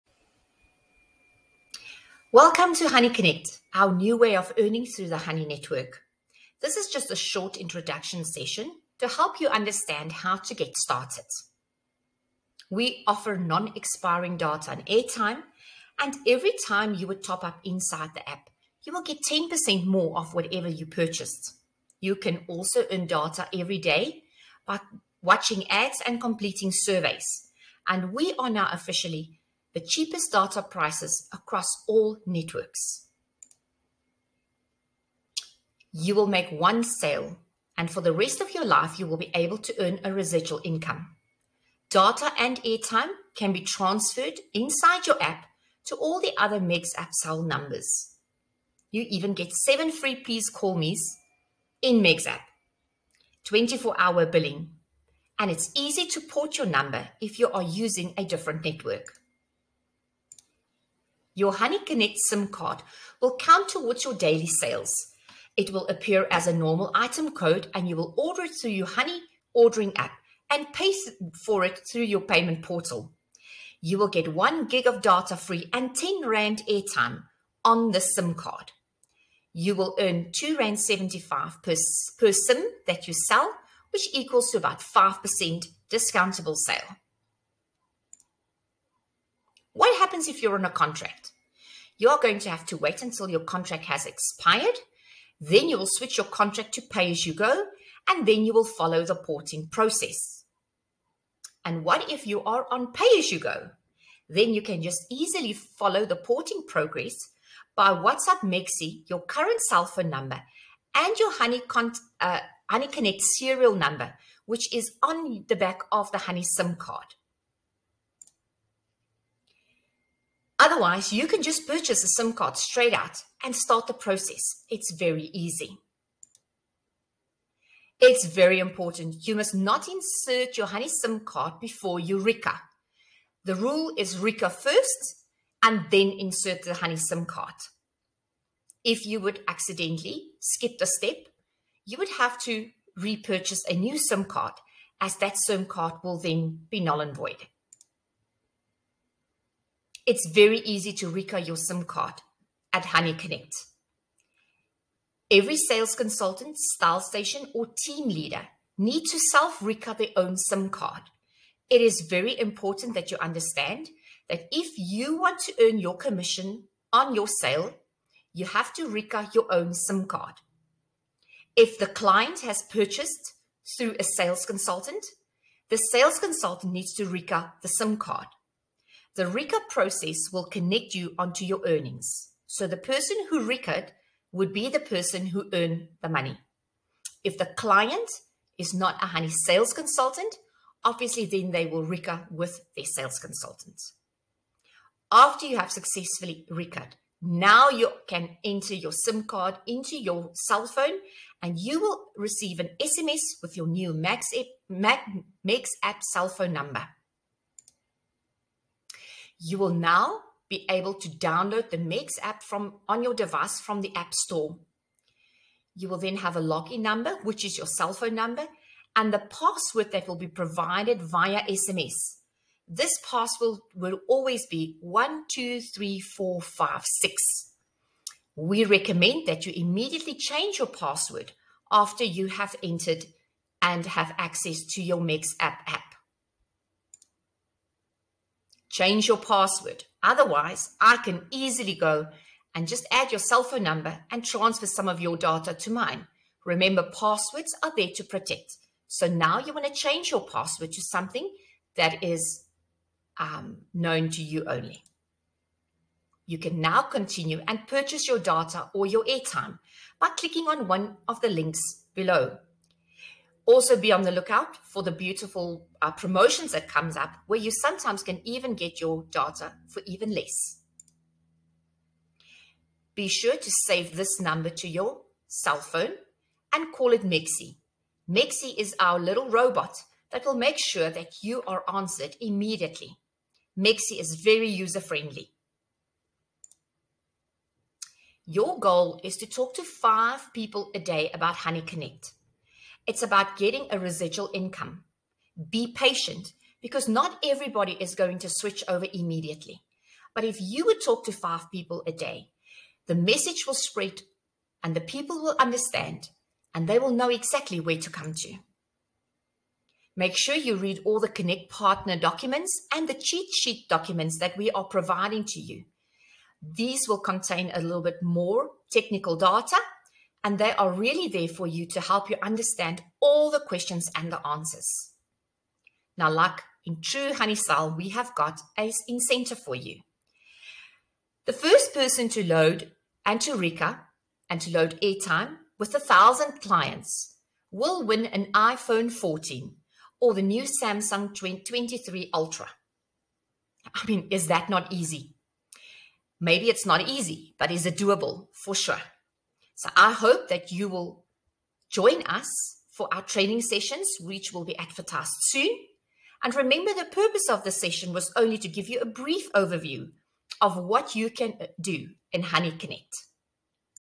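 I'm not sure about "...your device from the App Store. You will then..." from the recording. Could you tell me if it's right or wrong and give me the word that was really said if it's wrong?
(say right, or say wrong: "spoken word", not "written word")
right.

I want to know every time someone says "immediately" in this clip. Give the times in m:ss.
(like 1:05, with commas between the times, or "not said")
3:49, 4:42, 4:58.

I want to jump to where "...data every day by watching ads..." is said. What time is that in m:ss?
0:23.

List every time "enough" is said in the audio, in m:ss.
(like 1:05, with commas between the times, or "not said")
not said.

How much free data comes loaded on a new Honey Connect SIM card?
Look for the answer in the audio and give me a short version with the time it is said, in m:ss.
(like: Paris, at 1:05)
1 gig, at 1:14.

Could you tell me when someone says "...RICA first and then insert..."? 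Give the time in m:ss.
2:14.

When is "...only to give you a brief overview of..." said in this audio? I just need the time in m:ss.
5:58.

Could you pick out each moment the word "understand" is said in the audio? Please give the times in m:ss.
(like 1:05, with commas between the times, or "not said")
0:09, 2:43, 5:05, 5:22.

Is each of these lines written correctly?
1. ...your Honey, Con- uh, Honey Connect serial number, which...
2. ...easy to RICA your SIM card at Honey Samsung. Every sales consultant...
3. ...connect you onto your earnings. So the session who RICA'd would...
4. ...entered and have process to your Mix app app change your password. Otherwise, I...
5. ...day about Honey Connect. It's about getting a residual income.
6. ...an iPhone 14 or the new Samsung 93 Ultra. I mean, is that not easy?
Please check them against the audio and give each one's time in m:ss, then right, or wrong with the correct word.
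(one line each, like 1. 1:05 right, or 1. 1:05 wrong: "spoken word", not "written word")
1. 1:51 right
2. 2:30 wrong: "Connect", not "Samsung"
3. 3:00 wrong: "person", not "session"
4. 3:52 wrong: "access", not "process"
5. 4:50 right
6. 5:38 wrong: "23", not "93".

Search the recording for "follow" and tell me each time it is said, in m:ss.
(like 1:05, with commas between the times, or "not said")
1:38, 1:45.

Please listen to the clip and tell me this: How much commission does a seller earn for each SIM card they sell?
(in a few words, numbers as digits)
R2.75.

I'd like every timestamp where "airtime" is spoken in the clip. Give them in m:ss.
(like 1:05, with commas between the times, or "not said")
0:14, 0:42, 1:16, 4:19, 5:34.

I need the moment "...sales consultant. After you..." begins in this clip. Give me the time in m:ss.
3:12.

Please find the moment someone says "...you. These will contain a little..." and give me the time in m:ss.
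5:15.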